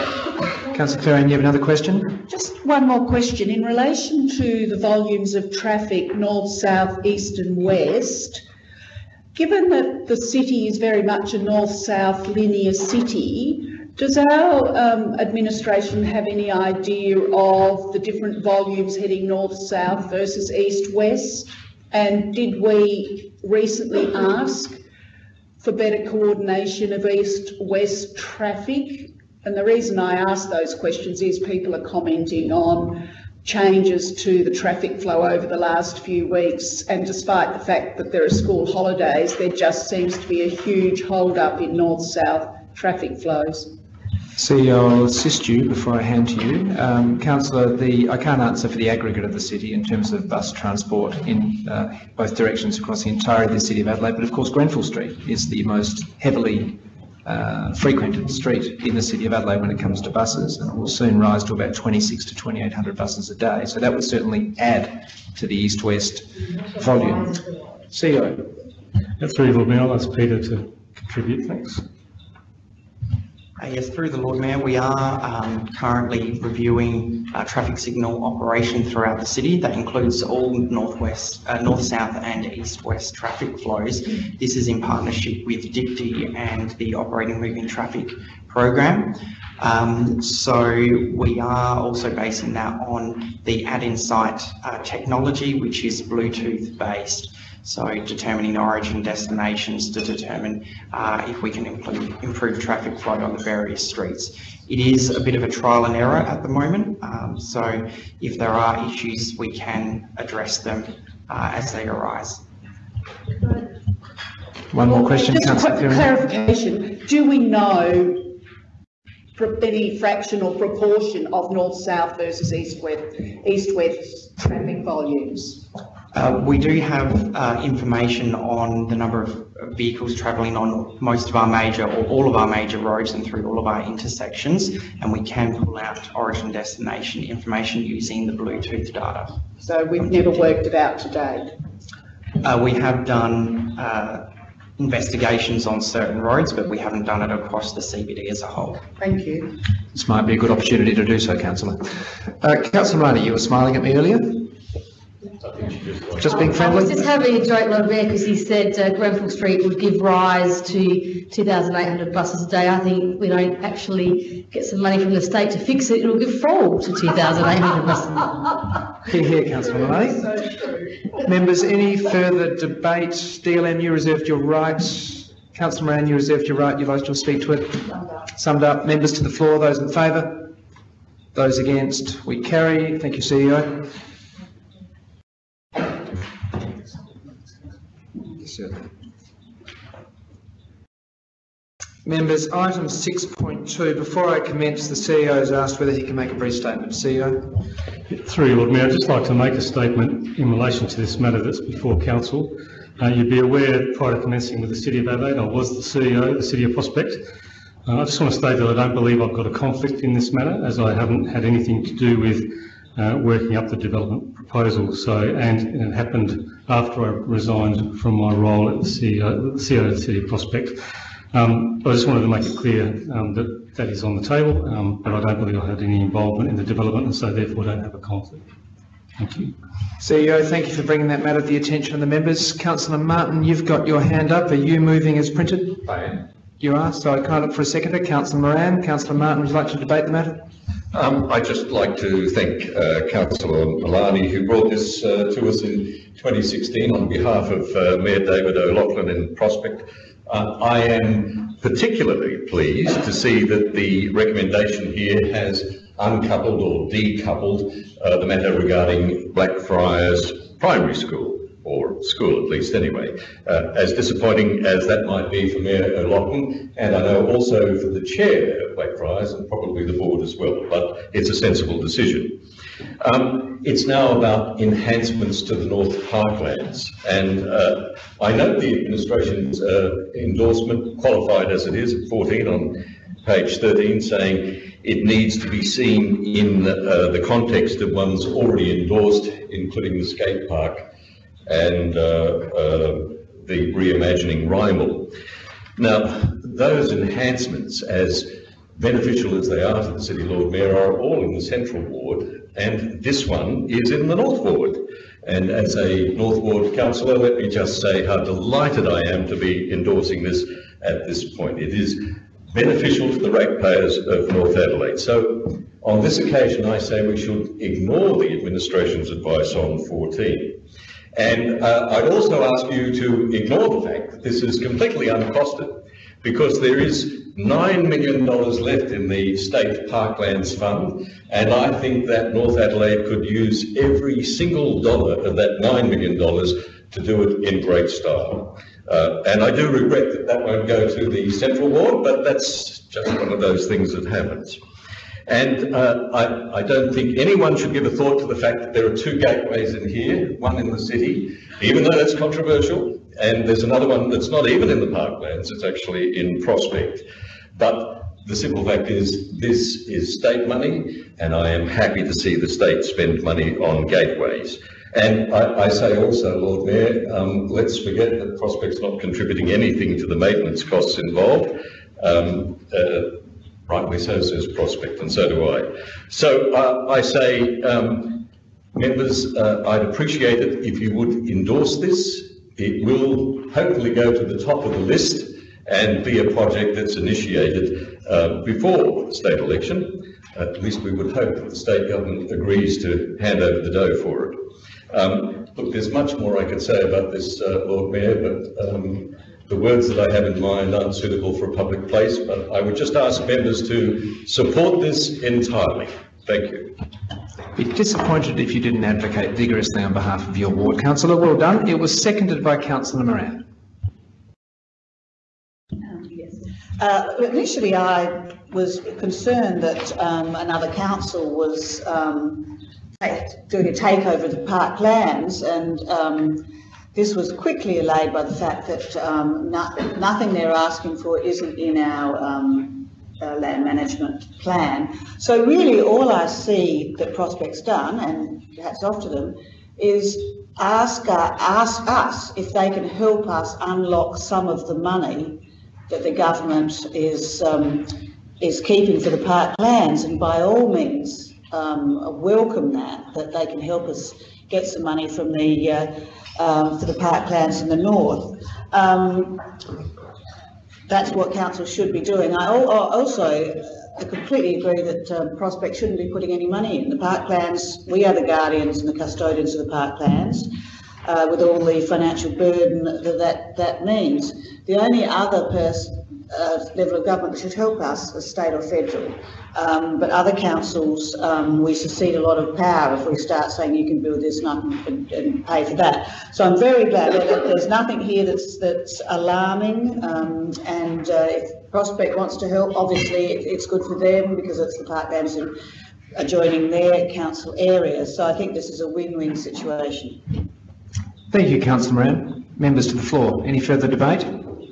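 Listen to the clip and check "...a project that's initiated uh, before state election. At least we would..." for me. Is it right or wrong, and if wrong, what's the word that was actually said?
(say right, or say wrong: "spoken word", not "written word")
right.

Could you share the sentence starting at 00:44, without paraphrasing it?
CEO, I'll assist you before I hand to you.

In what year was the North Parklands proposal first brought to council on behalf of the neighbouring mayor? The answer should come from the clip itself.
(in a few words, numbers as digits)
2016.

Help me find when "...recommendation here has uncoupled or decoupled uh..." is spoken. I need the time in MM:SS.
04:14.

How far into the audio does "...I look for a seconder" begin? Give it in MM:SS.
03:57.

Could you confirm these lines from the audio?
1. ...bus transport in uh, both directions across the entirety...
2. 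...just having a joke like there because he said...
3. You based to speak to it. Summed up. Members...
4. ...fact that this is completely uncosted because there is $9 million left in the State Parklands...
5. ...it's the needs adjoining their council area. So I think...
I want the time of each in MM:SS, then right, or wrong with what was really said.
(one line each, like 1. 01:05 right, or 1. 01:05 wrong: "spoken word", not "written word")
1. 00:50 right
2. 02:36 right
3. 02:56 wrong: "lodged", not "based"
4. 05:23 right
5. 08:14 wrong: "parklands", not "needs".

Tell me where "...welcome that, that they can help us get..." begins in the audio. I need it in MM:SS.
07:32.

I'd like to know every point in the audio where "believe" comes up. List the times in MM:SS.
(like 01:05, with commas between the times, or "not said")
03:28, 03:45.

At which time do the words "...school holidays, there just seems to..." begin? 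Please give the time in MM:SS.
00:38.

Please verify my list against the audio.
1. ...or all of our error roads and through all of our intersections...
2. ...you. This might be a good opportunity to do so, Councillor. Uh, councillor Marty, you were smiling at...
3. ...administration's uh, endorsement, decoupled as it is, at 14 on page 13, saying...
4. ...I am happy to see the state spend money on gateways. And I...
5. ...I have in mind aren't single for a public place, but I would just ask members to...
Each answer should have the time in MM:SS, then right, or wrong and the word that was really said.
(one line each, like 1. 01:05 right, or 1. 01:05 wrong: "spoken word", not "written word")
1. 02:11 wrong: "major", not "error"
2. 02:29 right
3. 04:38 wrong: "qualified", not "decoupled"
4. 06:01 right
5. 06:39 wrong: "suitable", not "single".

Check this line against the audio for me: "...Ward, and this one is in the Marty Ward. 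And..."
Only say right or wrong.
wrong.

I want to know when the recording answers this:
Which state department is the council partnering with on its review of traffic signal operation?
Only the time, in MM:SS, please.
01:25.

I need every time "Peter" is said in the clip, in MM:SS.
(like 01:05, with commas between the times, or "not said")
01:10.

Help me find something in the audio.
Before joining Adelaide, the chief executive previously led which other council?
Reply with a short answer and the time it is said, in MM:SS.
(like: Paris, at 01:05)
City of Prospect, at 03:26.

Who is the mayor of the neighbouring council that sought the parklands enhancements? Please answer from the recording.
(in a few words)
David O'Loughlin.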